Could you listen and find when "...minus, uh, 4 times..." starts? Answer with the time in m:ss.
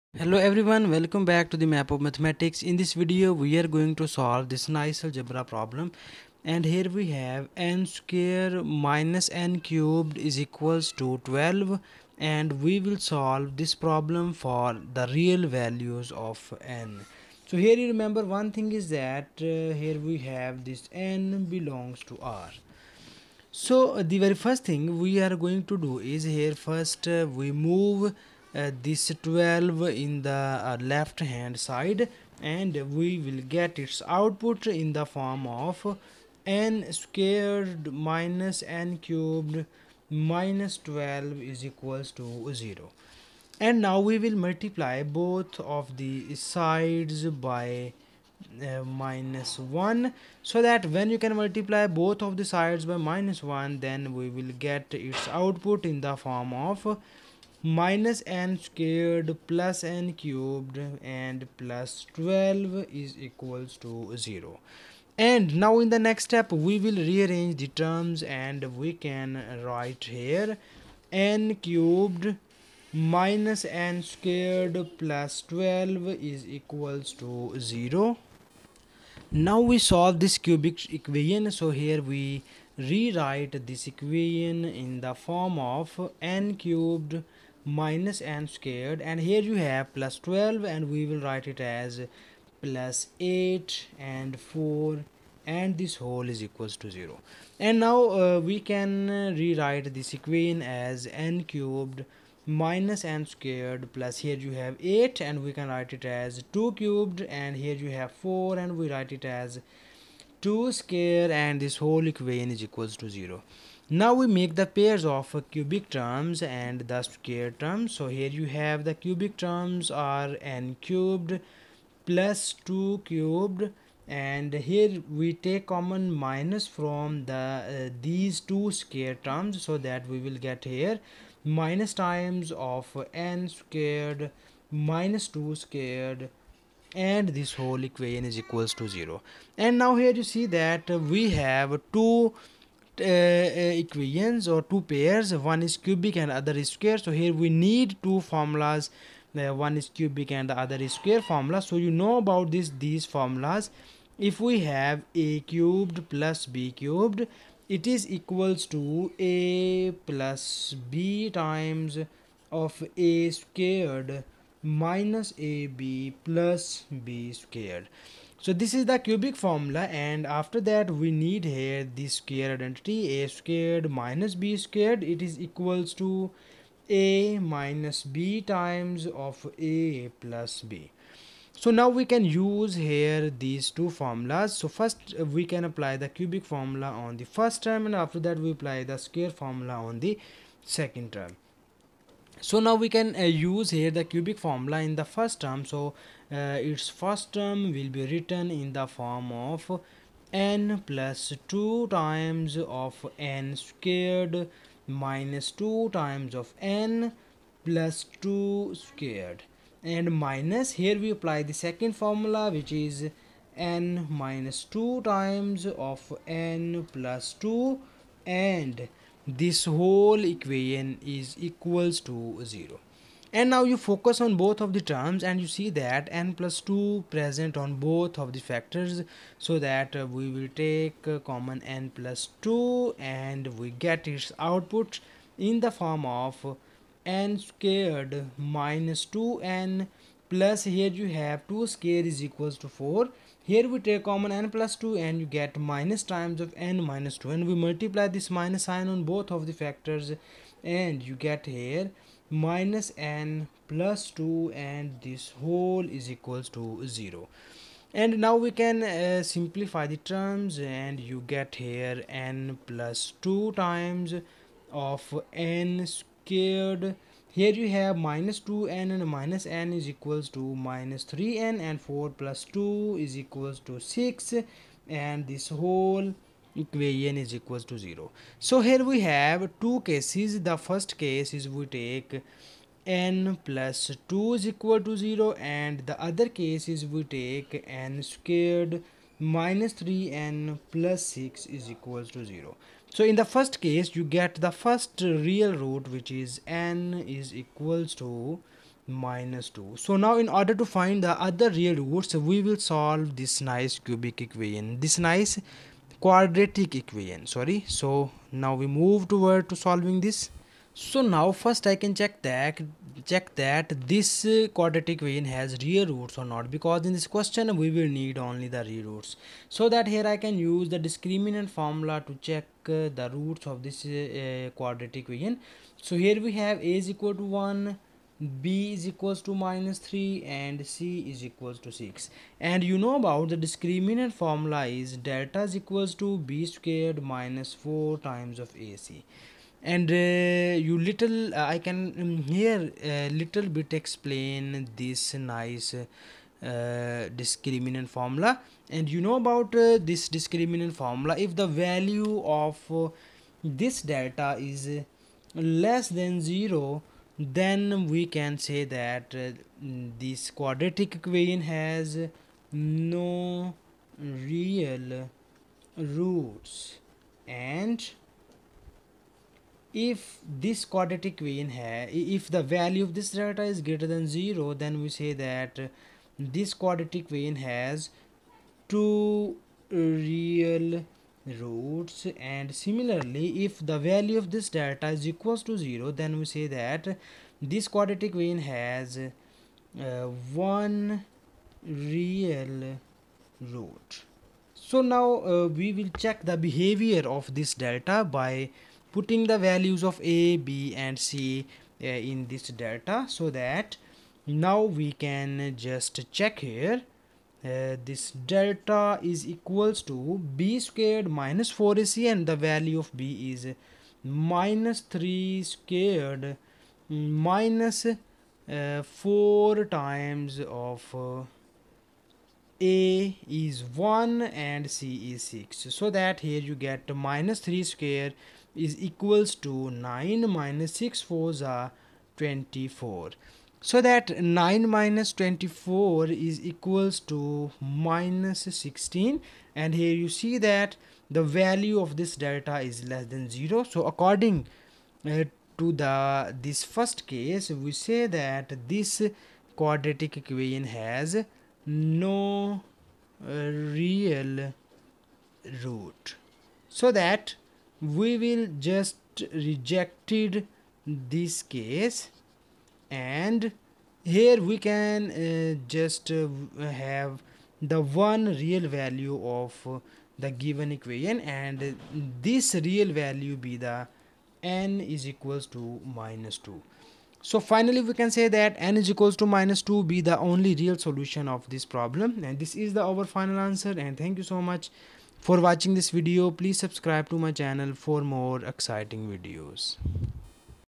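6:57.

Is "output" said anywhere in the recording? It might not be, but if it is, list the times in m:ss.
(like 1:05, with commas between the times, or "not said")
0:34, 0:55, 3:54.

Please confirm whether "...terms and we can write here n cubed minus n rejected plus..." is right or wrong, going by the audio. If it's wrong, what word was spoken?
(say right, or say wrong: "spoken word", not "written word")
wrong: "squared", not "rejected".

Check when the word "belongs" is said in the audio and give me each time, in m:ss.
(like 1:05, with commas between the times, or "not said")
0:21.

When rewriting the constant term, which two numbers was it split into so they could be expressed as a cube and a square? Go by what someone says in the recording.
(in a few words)
8 and 4.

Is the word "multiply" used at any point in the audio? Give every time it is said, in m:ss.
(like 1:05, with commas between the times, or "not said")
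0:44, 0:51, 4:07.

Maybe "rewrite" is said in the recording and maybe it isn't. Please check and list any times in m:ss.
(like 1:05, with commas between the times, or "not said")
1:22, 1:39.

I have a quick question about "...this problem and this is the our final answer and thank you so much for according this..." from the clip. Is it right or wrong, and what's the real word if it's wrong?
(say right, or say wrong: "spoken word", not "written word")
wrong: "watching", not "according".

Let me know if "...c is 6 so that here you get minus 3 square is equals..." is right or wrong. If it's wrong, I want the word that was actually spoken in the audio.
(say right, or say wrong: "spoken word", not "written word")
right.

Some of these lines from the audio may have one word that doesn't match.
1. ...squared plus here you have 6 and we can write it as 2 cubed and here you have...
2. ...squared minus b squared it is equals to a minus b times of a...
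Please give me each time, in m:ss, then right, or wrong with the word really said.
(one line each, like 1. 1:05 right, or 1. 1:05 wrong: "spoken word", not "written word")
1. 1:43 wrong: "8", not "6"
2. 2:53 right.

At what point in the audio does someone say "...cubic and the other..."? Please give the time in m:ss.
2:29.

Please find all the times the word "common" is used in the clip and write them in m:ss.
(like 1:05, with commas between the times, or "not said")
2:05, 3:51, 4:04.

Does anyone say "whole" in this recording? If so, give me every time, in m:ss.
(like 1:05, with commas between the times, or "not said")
1:35, 1:51, 2:17, 3:39, 4:15, 4:35.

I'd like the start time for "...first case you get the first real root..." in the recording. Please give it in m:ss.
4:53.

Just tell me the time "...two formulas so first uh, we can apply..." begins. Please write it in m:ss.
3:03.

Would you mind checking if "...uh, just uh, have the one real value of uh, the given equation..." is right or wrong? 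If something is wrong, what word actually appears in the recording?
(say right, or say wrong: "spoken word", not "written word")
right.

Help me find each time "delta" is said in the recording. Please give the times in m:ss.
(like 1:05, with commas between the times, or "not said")
5:34, 5:53, 6:13, 6:24, 6:37, 6:42, 6:48, 7:22.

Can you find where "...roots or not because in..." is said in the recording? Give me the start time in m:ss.
5:15.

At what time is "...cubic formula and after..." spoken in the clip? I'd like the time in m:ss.
2:48.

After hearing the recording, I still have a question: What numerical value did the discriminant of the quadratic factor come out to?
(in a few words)
-16.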